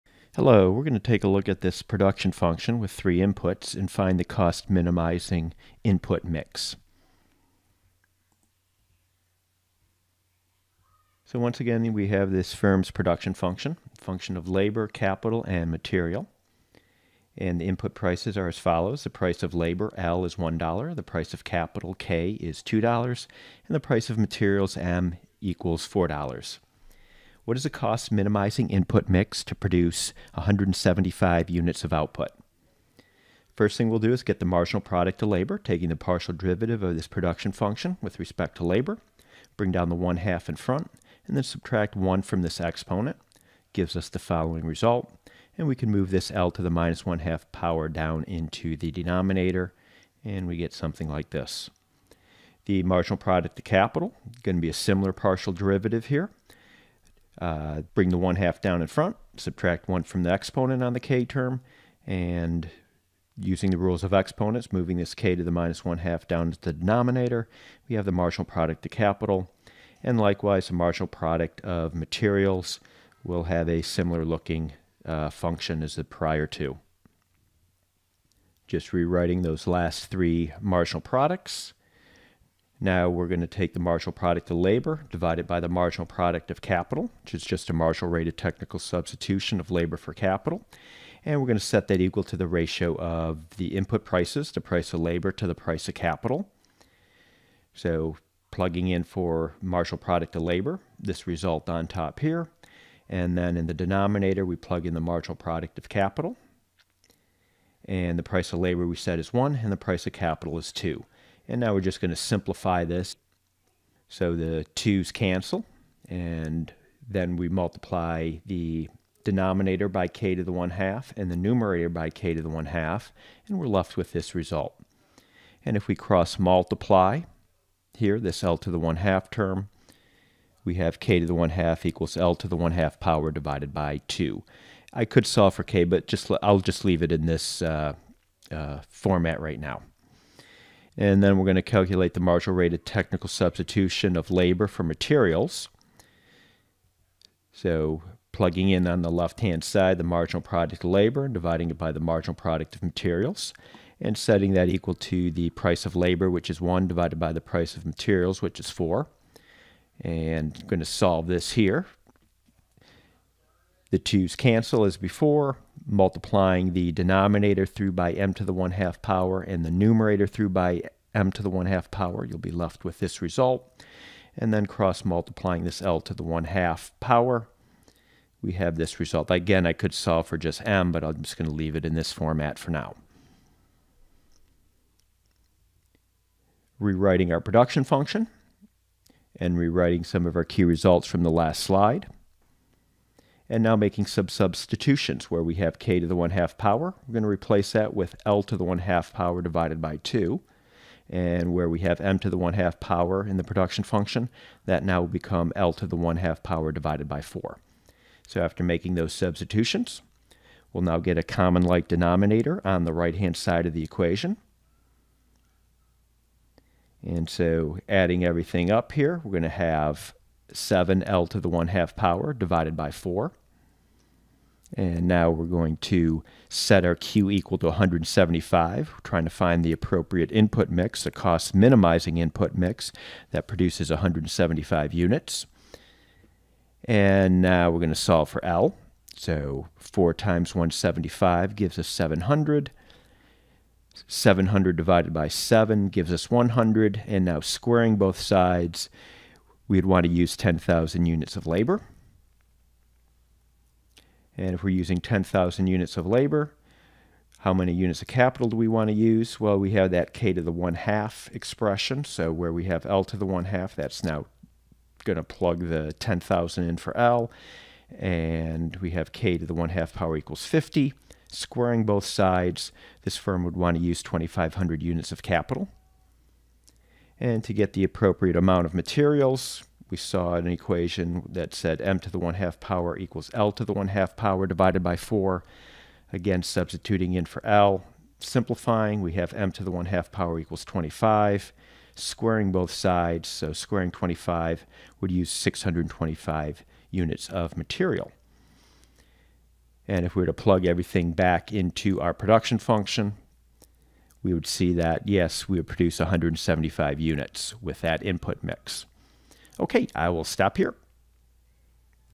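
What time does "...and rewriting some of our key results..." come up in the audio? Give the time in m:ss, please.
3:09.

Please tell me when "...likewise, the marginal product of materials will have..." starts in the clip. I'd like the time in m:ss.
1:10.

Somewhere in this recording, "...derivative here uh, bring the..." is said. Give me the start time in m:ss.
0:55.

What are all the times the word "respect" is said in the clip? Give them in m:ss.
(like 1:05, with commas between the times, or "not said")
0:38.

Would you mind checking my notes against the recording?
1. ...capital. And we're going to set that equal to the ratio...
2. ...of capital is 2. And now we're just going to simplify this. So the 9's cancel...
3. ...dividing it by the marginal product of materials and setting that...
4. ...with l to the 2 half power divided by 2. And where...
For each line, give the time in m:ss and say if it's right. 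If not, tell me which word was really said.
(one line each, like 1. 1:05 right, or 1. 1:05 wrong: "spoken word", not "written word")
1. 1:30 right
2. 1:50 wrong: "2", not "9"
3. 2:31 right
4. 3:17 wrong: "1", not "2".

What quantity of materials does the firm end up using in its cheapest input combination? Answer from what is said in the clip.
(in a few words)
625.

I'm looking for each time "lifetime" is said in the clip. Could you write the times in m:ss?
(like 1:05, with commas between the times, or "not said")
not said.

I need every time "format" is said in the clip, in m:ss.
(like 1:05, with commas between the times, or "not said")
2:18, 3:02.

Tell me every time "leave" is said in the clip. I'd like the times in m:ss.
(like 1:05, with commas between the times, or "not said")
2:16, 3:01.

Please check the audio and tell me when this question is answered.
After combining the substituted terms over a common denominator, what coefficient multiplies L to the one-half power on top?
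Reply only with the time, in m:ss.
3:40.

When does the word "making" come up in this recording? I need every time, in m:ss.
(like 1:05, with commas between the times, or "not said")
3:13, 3:28.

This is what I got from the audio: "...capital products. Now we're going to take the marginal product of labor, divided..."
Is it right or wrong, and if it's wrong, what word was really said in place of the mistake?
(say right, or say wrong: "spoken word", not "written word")
wrong: "marginal", not "capital".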